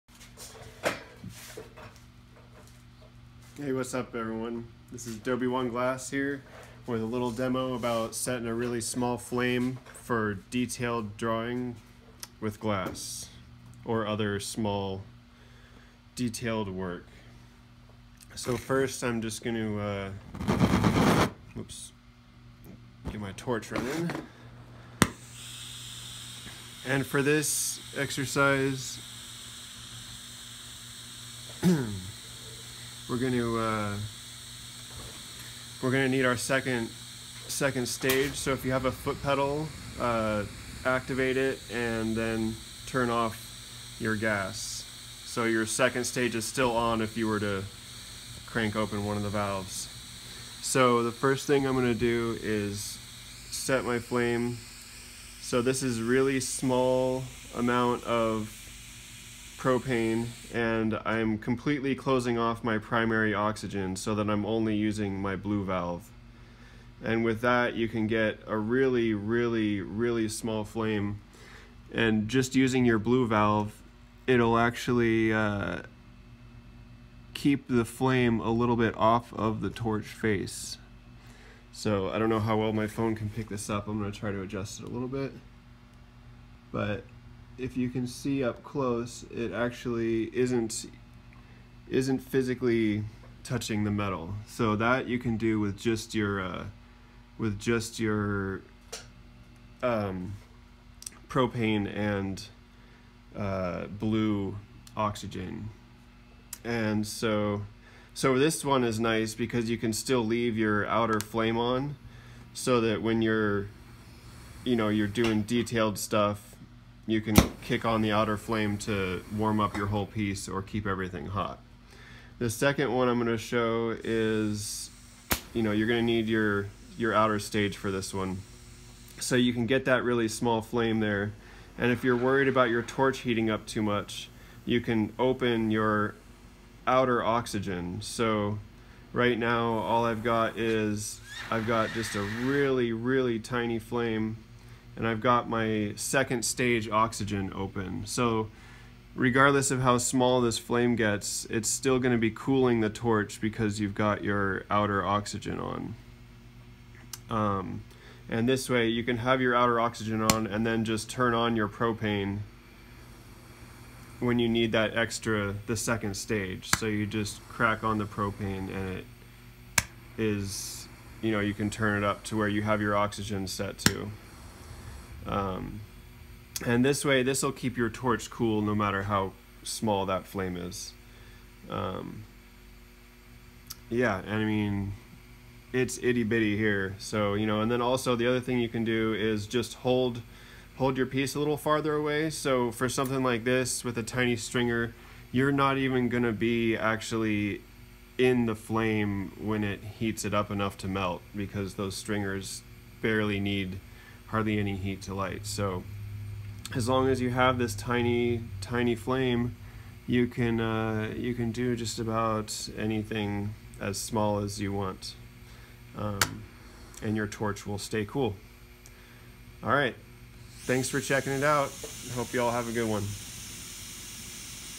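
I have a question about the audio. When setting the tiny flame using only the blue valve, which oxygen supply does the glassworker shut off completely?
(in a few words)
primary oxygen.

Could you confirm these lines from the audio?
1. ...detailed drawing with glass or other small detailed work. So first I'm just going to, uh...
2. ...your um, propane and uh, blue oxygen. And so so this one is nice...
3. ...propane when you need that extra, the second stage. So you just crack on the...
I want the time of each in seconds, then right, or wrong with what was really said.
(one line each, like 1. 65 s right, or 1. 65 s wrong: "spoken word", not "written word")
1. 10 s right
2. 97 s right
3. 161 s right.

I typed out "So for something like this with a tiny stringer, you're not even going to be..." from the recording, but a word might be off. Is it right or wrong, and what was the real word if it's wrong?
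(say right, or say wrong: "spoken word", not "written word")
right.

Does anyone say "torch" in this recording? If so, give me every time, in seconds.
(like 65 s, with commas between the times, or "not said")
23 s, 79 s, 132 s, 152 s, 177 s, 217 s.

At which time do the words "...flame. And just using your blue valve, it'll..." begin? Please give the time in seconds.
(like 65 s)
70 s.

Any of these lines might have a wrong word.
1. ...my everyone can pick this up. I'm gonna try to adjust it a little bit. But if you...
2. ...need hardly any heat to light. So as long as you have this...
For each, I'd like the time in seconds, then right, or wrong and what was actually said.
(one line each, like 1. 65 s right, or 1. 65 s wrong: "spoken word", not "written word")
1. 82 s wrong: "phone", not "everyone"
2. 203 s right.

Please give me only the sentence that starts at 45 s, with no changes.
So your second stage is still on if you were to crank open one of the valves.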